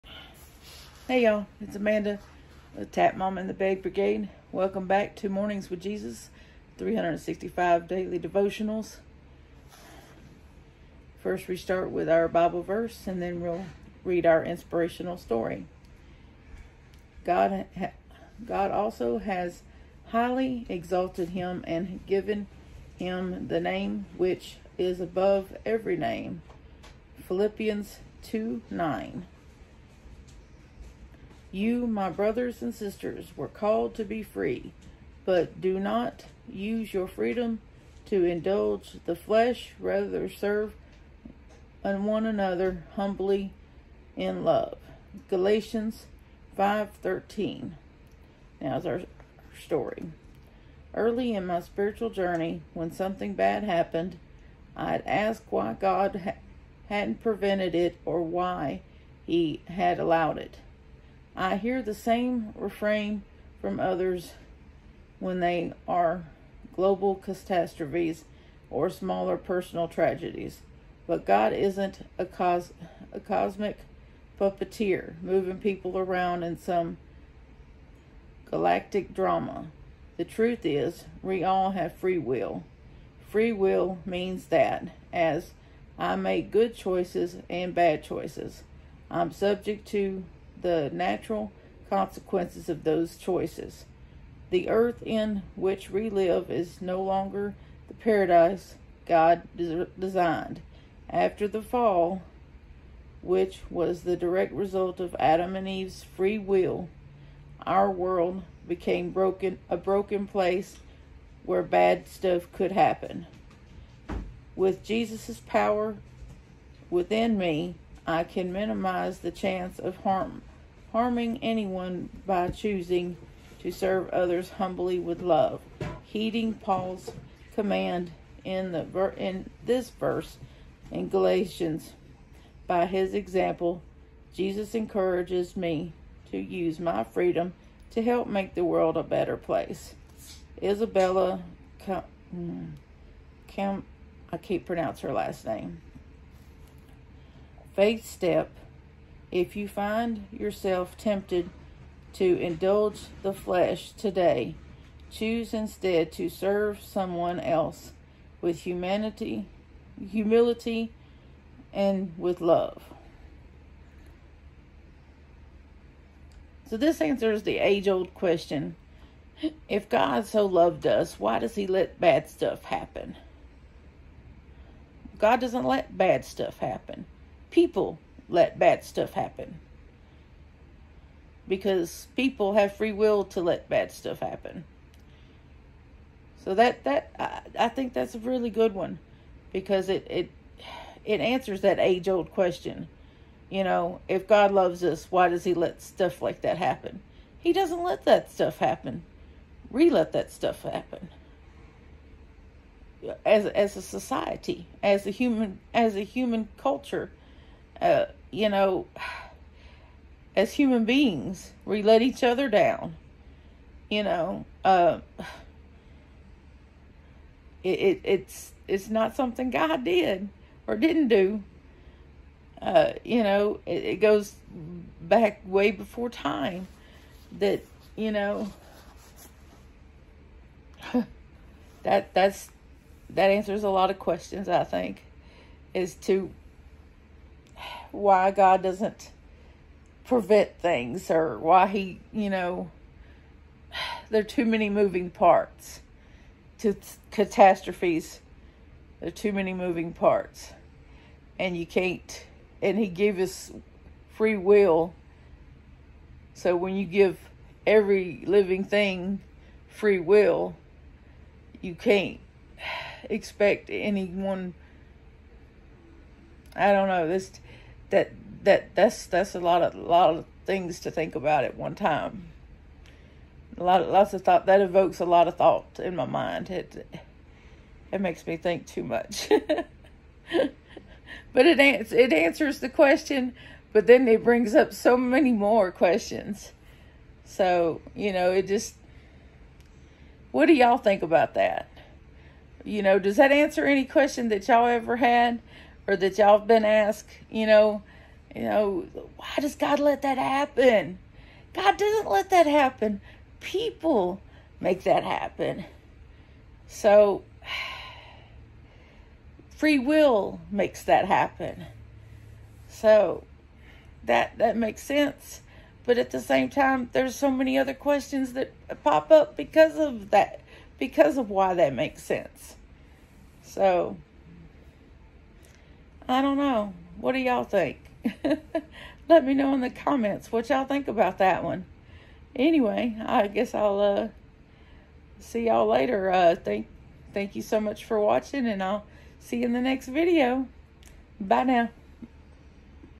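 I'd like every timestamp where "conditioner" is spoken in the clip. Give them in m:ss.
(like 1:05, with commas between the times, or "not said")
not said.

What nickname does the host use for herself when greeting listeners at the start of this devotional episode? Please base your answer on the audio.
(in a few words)
Amanda the Tap Mom.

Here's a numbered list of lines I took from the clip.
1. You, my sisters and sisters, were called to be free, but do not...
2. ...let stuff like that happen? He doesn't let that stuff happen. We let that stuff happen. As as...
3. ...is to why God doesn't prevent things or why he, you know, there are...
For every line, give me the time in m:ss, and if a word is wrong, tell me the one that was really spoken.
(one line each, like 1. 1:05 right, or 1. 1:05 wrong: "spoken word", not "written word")
1. 0:31 wrong: "brothers", not "sisters"
2. 3:15 right
3. 3:55 right.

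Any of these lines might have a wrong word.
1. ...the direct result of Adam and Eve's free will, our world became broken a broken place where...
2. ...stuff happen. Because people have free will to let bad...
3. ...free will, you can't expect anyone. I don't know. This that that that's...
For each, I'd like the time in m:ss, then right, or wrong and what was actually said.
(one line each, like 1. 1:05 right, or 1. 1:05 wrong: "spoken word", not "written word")
1. 1:44 right
2. 2:58 right
3. 4:19 right.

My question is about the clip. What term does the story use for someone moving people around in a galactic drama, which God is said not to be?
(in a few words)
cosmic puppeteer.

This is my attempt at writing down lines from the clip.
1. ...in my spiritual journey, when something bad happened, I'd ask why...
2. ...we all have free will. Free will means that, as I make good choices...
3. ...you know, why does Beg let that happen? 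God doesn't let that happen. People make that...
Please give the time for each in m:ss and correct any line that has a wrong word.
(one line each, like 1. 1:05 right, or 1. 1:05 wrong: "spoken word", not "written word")
1. 0:51 right
2. 1:21 right
3. 4:58 wrong: "God", not "Beg".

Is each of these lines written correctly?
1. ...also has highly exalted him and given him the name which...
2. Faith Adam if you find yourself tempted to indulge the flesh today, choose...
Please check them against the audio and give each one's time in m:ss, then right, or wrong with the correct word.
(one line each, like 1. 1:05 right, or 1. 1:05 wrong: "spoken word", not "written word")
1. 0:18 right
2. 2:27 wrong: "Step", not "Adam".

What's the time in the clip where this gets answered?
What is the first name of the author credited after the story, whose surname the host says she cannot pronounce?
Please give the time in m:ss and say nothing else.
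2:20.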